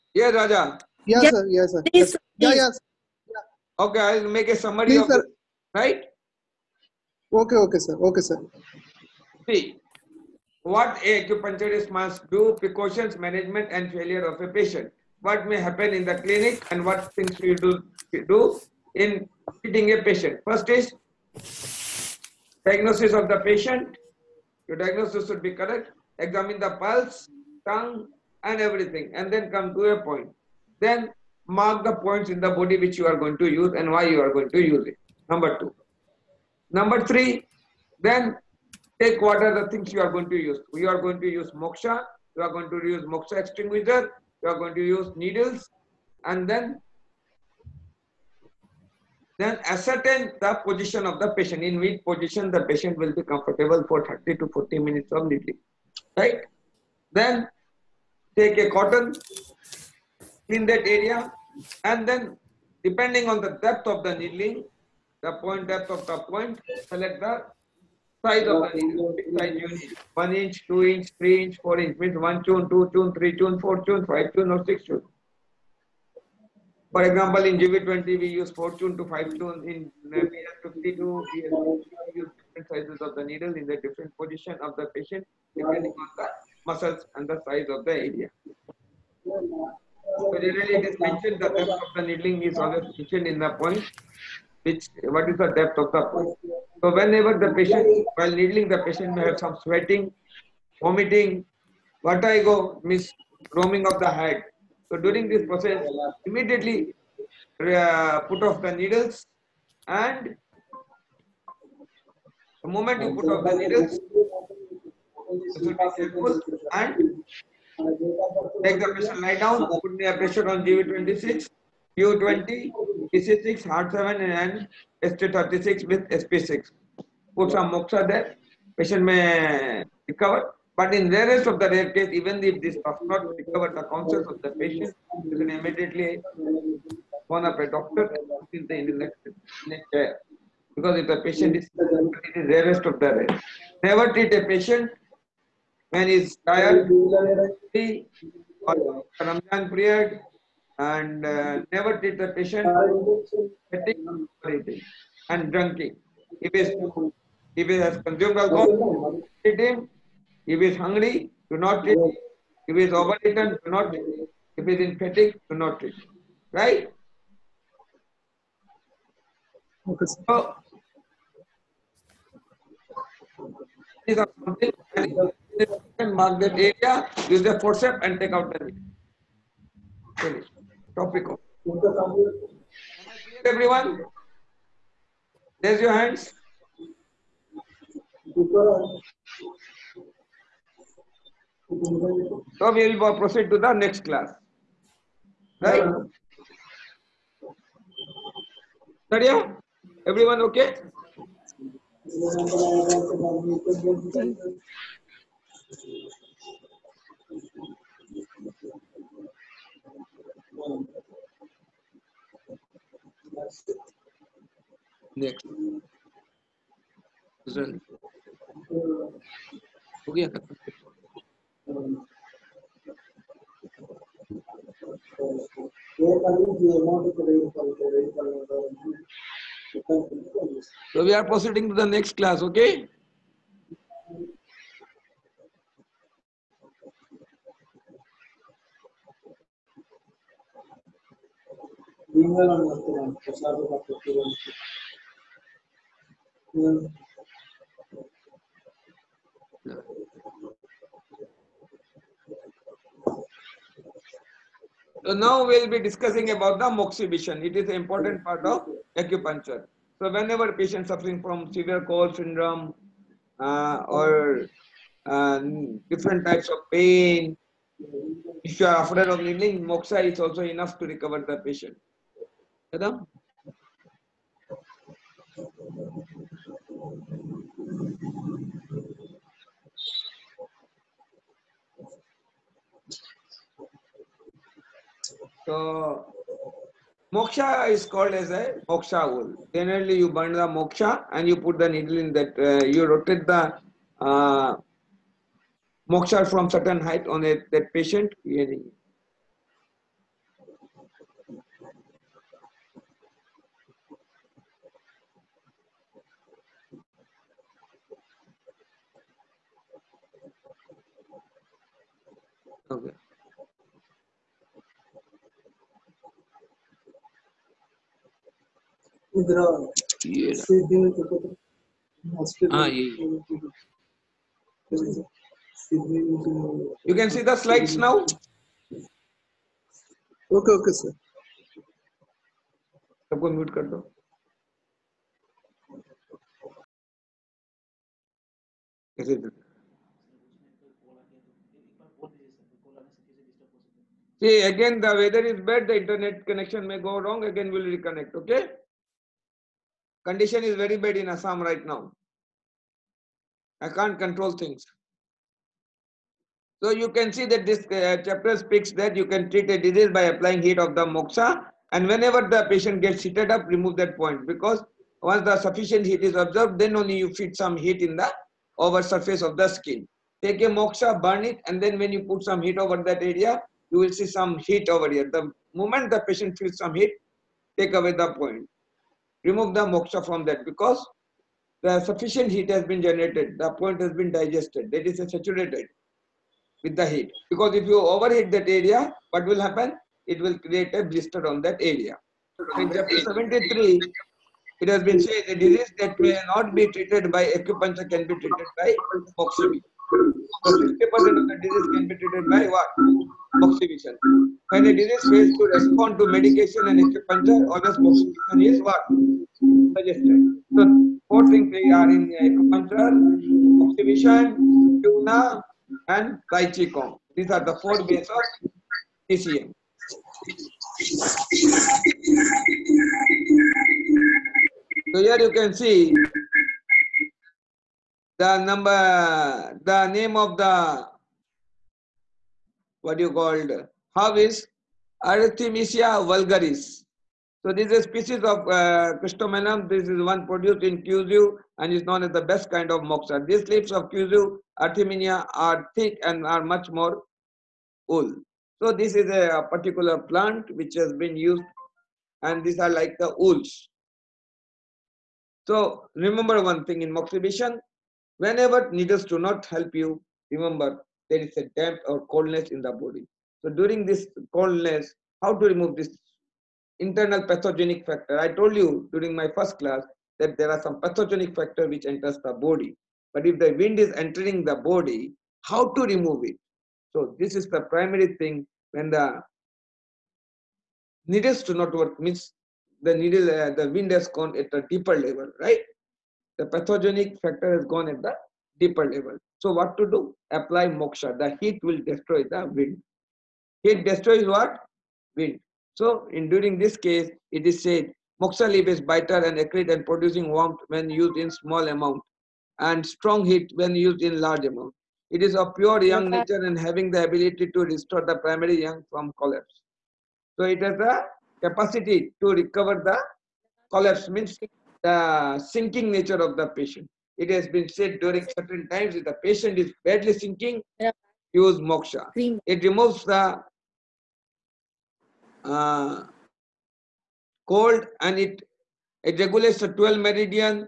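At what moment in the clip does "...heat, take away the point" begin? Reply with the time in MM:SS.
06:16.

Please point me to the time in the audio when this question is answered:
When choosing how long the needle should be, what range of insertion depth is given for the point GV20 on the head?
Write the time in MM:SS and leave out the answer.
01:18.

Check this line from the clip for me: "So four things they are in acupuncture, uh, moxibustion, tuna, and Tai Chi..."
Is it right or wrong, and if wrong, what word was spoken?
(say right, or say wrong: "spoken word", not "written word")
right.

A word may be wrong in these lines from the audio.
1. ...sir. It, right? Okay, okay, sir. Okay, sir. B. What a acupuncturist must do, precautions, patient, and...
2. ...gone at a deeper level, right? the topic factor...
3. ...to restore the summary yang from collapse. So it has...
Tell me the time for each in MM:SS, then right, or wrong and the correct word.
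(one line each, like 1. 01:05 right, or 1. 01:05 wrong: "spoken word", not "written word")
1. 00:05 wrong: "management", not "patient"
2. 08:04 wrong: "pathogenic", not "topic"
3. 08:27 wrong: "primary", not "summary".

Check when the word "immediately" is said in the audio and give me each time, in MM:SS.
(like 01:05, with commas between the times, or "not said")
01:46, 02:15.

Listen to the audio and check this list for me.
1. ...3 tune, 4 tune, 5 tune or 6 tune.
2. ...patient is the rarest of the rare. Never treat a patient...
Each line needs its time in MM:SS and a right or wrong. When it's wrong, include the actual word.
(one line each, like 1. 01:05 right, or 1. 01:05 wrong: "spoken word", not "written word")
1. 01:13 right
2. 02:21 right.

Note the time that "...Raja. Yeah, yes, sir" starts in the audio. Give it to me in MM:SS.
00:00.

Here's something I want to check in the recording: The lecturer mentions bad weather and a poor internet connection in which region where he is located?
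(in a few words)
Assam.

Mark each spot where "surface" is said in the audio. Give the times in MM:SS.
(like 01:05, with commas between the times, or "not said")
06:08.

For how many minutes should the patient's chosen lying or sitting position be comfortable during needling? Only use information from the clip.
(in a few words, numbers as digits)
30 to 40 minutes.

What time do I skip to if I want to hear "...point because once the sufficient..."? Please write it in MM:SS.
06:03.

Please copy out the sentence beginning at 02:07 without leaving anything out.
Put some moxa there, patient may recover.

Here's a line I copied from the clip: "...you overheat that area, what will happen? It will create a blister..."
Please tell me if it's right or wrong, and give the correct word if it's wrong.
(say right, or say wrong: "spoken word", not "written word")
right.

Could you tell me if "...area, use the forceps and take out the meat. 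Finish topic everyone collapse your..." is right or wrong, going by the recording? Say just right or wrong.
wrong.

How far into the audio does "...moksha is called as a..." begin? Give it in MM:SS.
04:47.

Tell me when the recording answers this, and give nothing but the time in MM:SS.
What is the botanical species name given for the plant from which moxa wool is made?
07:15.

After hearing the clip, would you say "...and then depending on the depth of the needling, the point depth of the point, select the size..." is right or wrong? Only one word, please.
right.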